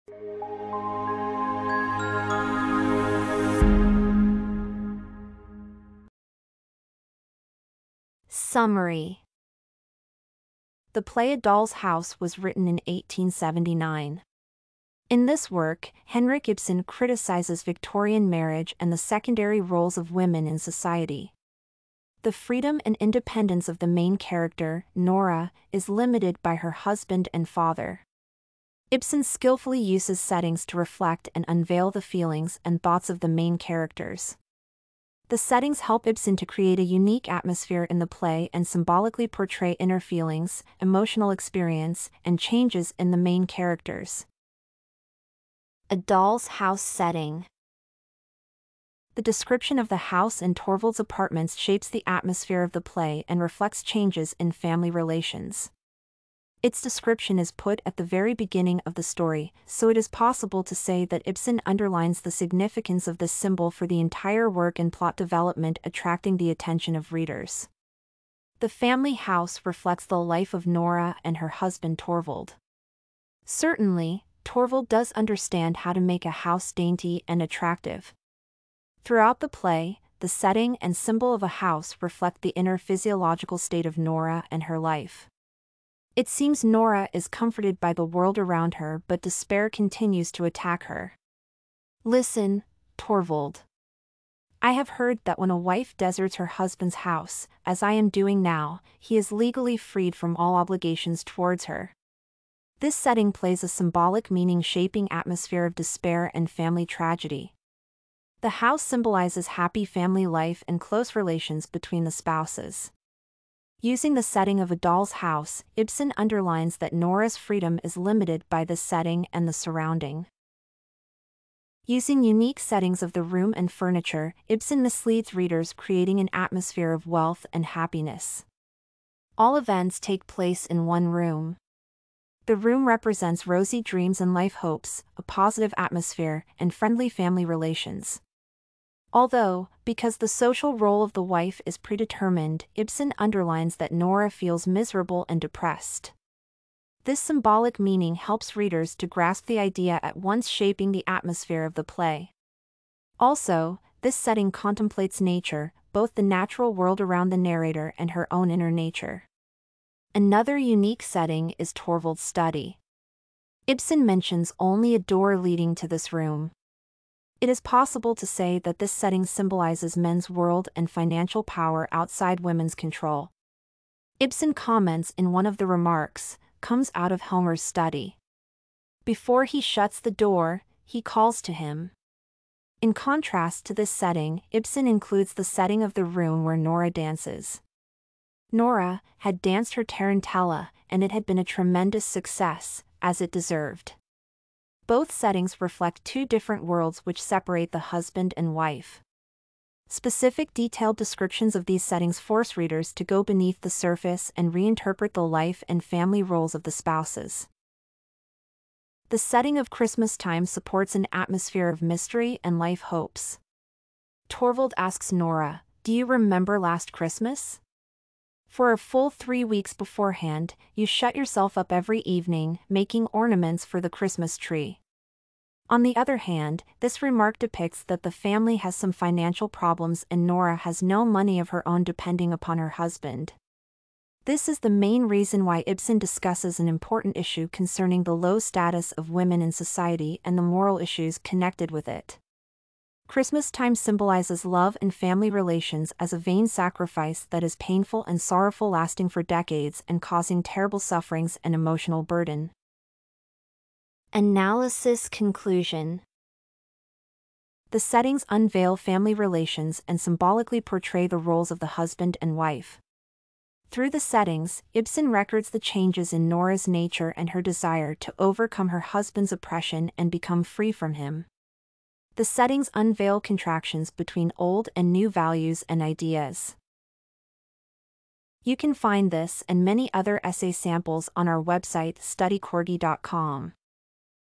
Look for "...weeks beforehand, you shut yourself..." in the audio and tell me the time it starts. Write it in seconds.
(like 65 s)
219 s.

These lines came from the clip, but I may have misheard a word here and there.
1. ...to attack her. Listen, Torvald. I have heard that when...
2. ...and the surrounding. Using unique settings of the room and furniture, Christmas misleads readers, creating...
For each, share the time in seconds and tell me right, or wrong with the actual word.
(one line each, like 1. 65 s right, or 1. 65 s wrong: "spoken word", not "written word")
1. 90 s right
2. 119 s wrong: "Ibsen", not "Christmas".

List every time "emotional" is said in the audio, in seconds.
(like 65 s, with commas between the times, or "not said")
40 s, 251 s.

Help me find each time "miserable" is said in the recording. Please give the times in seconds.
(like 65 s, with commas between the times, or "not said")
144 s.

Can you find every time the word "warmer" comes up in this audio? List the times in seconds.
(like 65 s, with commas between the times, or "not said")
not said.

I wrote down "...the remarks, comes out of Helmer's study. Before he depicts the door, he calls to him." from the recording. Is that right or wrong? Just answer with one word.
wrong.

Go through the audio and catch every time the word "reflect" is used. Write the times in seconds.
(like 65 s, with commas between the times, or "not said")
30 s, 53 s, 69 s, 82 s, 195 s.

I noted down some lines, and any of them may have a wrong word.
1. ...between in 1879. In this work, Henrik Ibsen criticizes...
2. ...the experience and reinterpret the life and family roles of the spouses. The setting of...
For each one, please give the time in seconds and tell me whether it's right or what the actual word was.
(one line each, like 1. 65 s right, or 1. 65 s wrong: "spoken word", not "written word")
1. 12 s wrong: "written", not "between"
2. 203 s wrong: "surface", not "experience".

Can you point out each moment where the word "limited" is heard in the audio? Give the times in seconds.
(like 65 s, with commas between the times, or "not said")
25 s, 117 s.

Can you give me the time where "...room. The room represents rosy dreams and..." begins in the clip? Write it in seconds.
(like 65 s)
131 s.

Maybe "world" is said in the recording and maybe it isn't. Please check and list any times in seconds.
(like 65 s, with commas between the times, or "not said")
88 s, 156 s, 170 s, 196 s.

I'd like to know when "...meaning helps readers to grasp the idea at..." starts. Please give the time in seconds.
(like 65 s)
147 s.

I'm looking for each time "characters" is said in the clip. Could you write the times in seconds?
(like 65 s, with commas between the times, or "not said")
24 s, 33 s, 43 s.